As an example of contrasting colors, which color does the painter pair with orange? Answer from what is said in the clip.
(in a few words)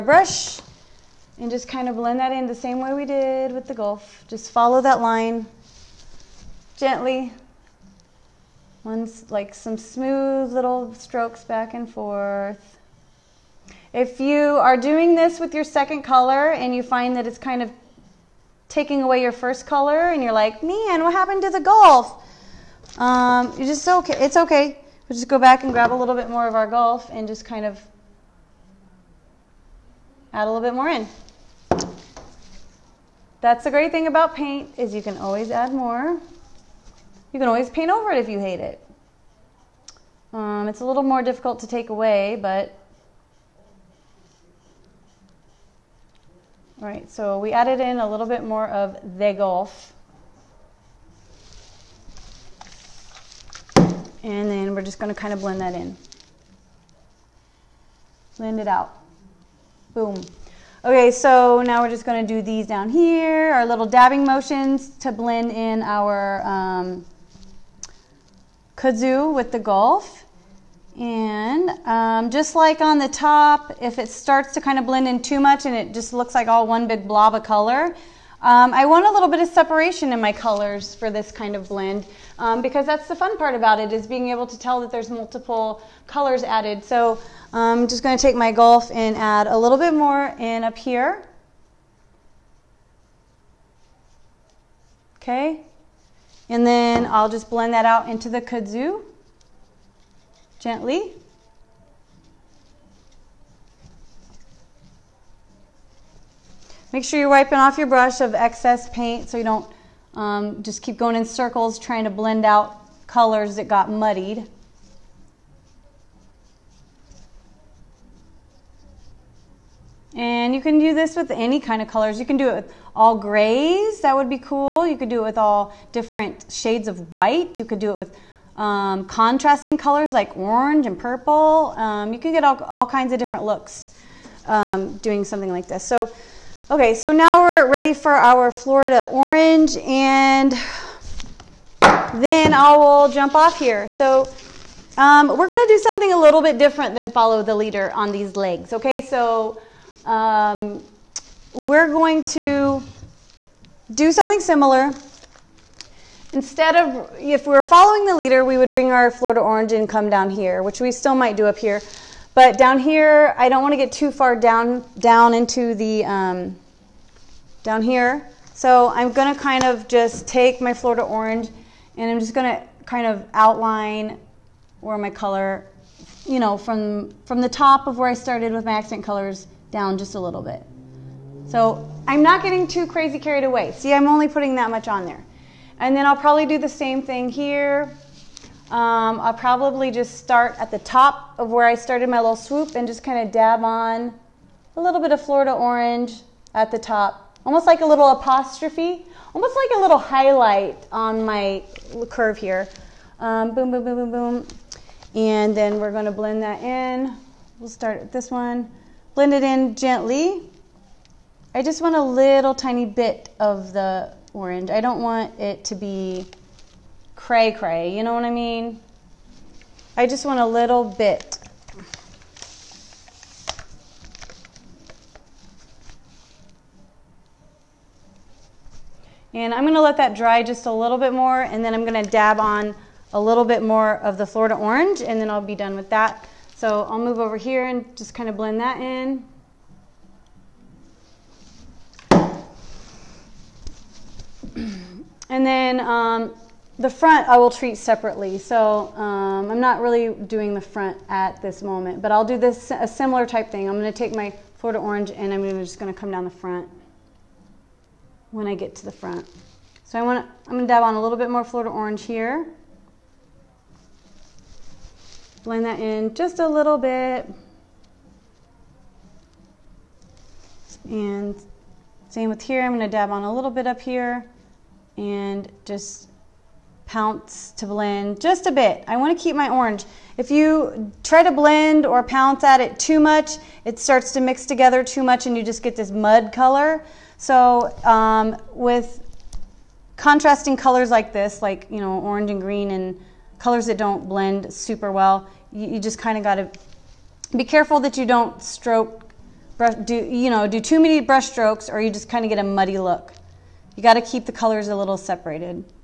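Purple.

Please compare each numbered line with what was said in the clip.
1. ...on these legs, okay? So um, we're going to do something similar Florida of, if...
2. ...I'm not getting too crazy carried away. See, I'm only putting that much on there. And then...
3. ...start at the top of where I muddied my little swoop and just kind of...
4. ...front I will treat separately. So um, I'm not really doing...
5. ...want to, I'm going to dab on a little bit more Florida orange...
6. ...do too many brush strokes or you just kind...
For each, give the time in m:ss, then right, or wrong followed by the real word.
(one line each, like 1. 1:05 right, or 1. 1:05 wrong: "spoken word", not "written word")
1. 2:27 wrong: "Instead", not "Florida"
2. 3:02 right
3. 3:10 wrong: "started", not "muddied"
4. 4:06 right
5. 4:20 right
6. 5:00 right.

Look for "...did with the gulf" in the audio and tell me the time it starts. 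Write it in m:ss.
0:03.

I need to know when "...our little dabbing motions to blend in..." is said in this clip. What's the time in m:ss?
1:03.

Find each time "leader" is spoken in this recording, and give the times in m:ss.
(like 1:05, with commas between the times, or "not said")
2:27, 2:38.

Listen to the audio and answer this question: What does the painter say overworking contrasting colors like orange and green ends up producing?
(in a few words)
Mud color.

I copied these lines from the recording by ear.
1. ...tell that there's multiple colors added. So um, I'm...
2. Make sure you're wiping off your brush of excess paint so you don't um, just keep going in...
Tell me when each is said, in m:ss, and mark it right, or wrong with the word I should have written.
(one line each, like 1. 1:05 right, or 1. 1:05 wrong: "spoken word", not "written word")
1. 1:24 right
2. 1:46 right.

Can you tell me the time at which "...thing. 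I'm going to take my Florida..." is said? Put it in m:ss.
4:13.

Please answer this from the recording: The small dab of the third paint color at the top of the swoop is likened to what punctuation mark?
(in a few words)
Apostrophe.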